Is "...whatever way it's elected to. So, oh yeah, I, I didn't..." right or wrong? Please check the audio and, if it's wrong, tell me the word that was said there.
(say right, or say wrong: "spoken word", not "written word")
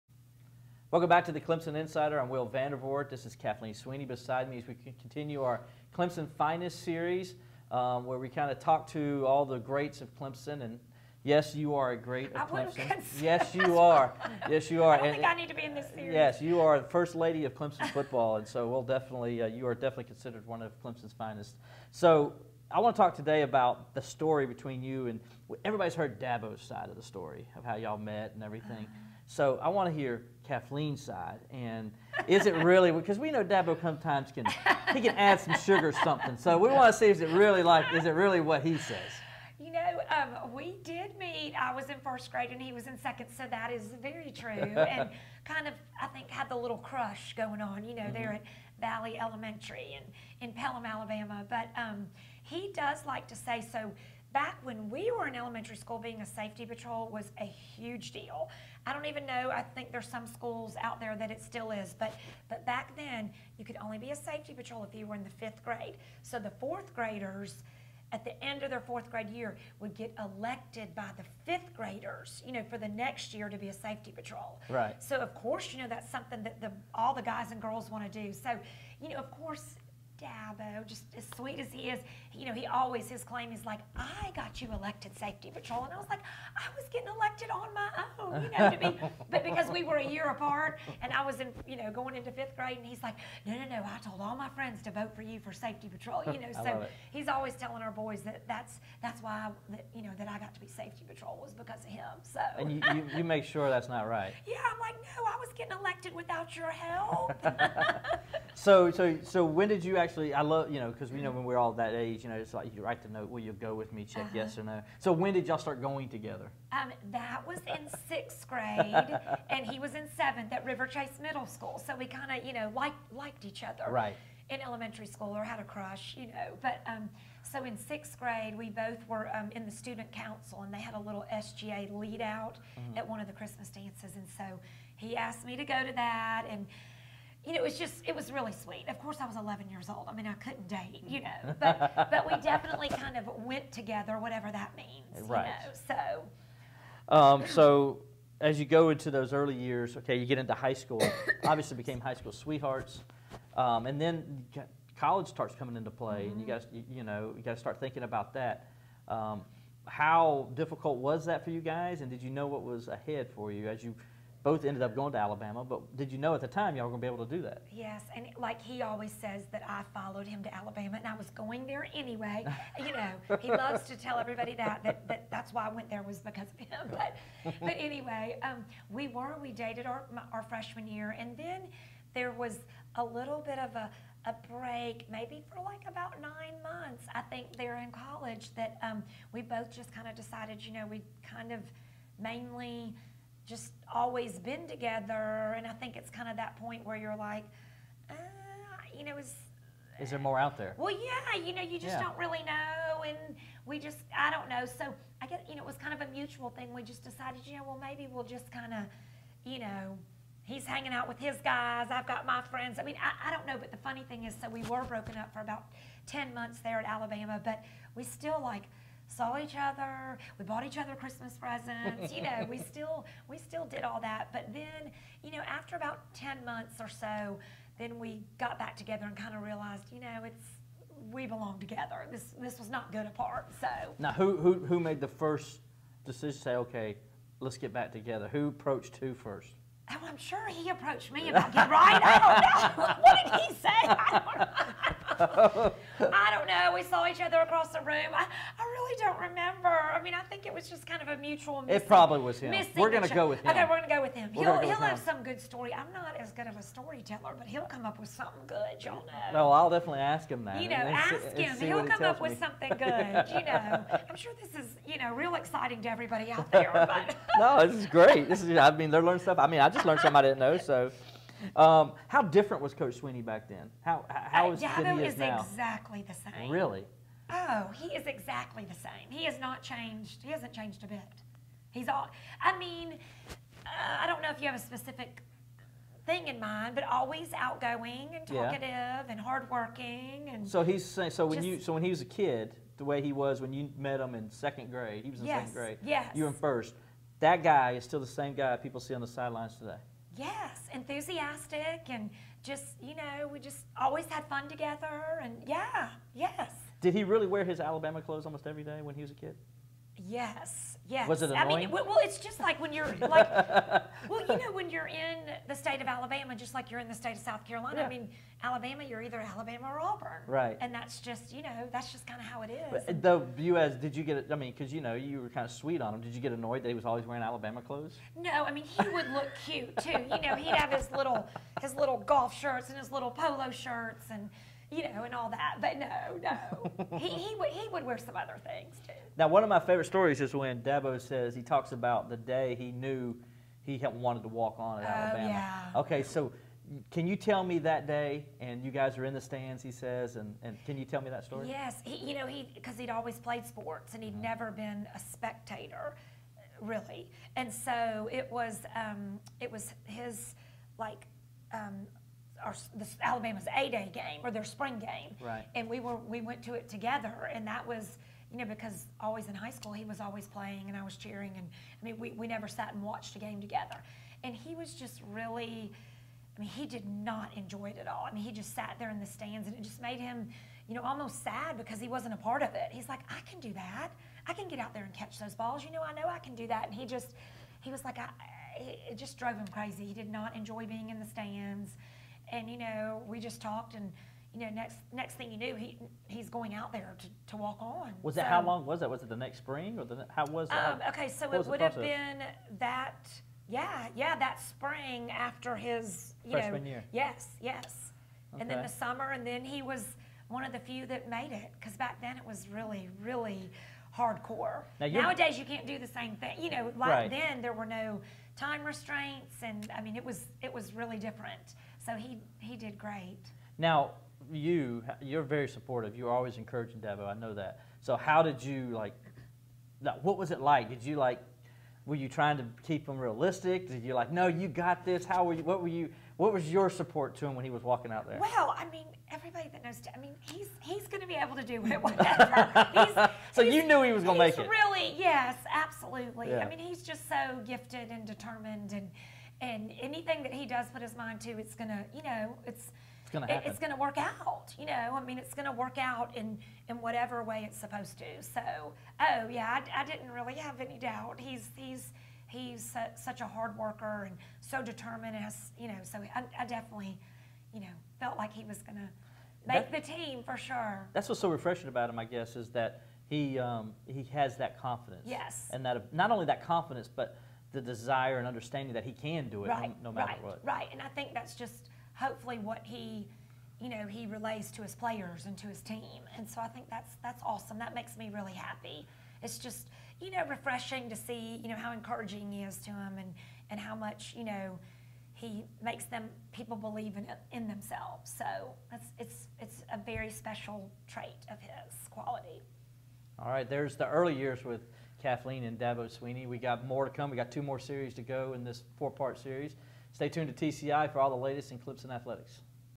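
wrong: "supposed", not "elected".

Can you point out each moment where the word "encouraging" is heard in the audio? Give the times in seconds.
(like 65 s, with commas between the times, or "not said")
426 s, 491 s.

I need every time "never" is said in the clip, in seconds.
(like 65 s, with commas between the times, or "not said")
354 s, 372 s.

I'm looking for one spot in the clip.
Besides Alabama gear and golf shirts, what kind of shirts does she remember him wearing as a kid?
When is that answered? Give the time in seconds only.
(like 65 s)
333 s.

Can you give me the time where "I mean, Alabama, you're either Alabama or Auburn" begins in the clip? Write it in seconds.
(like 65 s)
317 s.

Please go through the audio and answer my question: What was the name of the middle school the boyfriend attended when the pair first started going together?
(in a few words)
Riverchase Middle School.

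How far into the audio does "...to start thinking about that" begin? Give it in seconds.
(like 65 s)
157 s.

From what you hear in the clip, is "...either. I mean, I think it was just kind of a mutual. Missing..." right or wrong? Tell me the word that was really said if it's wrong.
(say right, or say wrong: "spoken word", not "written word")
wrong: "remember", not "either".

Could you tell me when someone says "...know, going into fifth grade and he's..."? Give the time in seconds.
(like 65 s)
91 s.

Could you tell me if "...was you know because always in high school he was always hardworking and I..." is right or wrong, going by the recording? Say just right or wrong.
wrong.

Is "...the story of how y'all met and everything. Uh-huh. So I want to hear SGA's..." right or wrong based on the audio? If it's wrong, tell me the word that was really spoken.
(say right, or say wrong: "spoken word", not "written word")
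wrong: "Kathleen", not "SGA".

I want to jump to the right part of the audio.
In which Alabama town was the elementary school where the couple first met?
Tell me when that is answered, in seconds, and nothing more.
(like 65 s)
50 s.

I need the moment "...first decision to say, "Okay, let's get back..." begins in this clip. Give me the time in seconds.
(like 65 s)
235 s.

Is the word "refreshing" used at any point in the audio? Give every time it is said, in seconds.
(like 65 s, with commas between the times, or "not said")
471 s, 490 s.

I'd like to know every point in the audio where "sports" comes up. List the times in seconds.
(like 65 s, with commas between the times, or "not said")
353 s.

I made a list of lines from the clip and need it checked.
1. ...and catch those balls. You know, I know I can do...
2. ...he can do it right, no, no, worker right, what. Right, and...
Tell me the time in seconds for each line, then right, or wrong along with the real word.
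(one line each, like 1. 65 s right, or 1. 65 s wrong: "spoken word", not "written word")
1. 384 s right
2. 478 s wrong: "matter", not "worker".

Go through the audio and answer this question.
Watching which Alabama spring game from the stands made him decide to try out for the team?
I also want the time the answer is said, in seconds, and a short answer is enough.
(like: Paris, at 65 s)
A Day game, at 363 s.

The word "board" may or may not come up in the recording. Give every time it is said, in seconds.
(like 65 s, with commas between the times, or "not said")
not said.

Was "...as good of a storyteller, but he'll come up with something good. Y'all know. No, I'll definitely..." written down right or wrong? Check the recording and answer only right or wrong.
right.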